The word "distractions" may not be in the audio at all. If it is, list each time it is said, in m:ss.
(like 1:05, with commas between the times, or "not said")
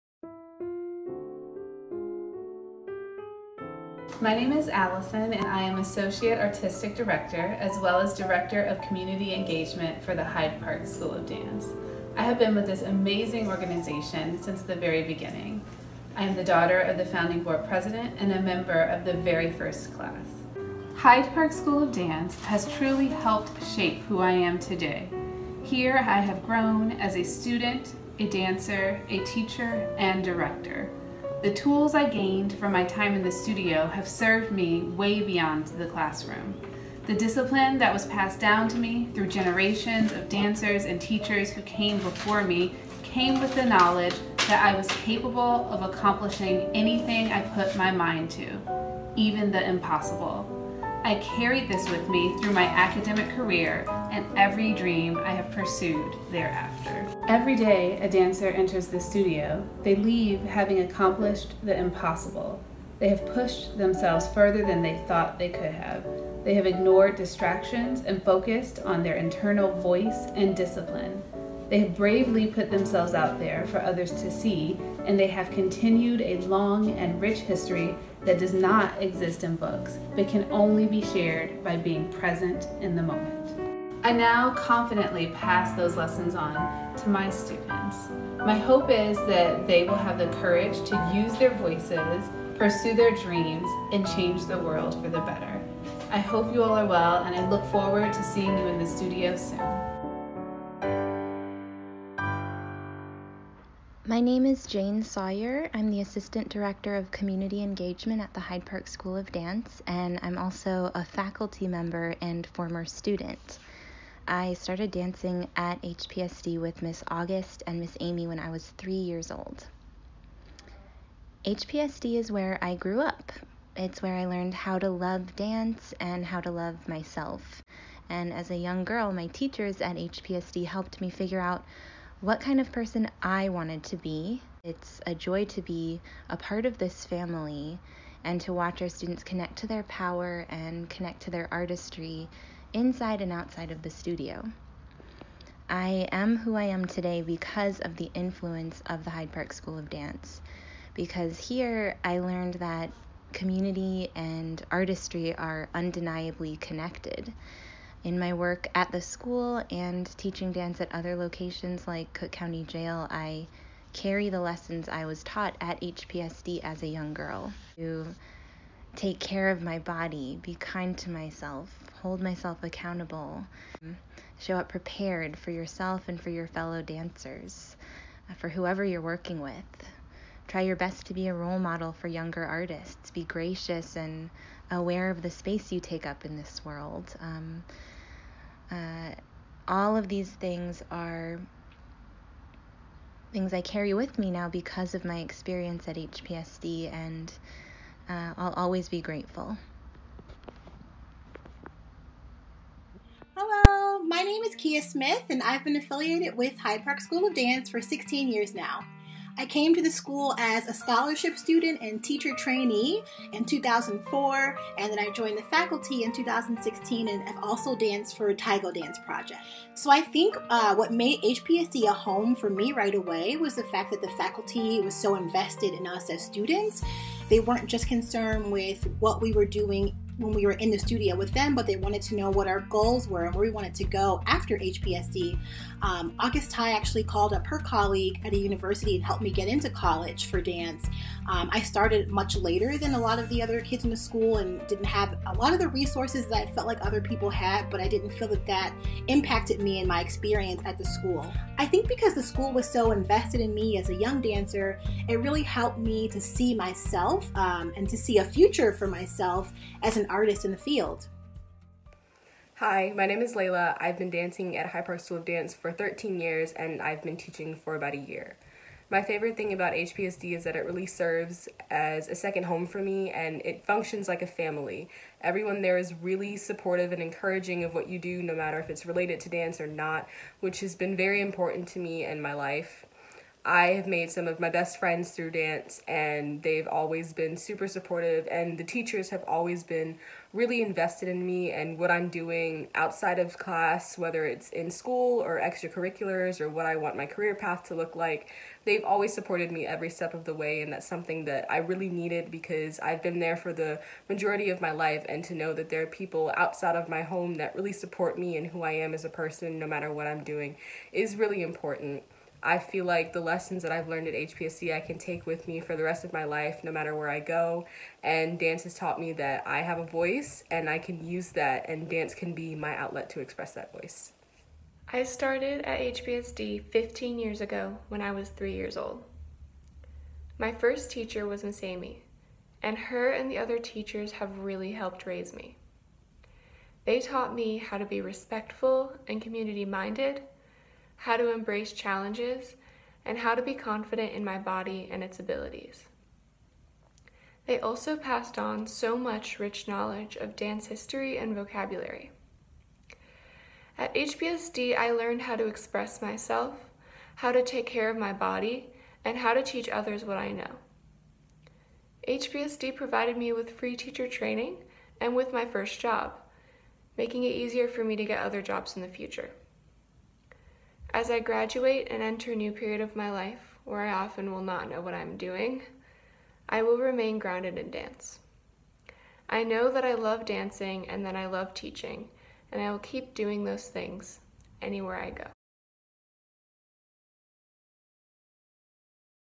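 1:07.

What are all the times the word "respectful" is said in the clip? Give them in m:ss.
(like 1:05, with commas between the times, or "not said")
5:38.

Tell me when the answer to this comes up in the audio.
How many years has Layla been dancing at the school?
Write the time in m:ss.
4:25.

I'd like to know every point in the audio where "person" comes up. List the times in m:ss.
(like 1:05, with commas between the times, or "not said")
2:12, 5:09.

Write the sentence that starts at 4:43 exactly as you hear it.
I have made some of my best friends through dance, and they've always been super supportive.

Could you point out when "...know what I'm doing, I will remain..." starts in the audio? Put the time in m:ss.
6:14.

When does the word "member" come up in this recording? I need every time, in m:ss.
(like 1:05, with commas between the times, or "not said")
0:18, 1:51.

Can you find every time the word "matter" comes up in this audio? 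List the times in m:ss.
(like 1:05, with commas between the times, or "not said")
4:38, 5:09, 5:16.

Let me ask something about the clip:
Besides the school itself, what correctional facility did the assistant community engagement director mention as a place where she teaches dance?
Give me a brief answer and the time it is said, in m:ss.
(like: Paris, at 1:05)
Cook County Jail, at 2:42.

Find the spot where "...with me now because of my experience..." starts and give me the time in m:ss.
3:13.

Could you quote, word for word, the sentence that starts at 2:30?
Because here I learned that community and artistry are undeniably connected.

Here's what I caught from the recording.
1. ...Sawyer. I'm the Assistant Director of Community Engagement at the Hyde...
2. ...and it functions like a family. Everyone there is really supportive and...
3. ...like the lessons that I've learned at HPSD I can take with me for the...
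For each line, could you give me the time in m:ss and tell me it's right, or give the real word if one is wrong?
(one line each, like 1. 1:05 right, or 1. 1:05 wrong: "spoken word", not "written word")
1. 1:45 right
2. 4:33 right
3. 5:12 right.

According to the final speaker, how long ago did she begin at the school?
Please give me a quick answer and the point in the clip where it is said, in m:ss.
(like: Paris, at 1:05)
15 years, at 5:26.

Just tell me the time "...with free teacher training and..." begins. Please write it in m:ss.
6:03.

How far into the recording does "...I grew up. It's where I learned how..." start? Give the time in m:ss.
2:02.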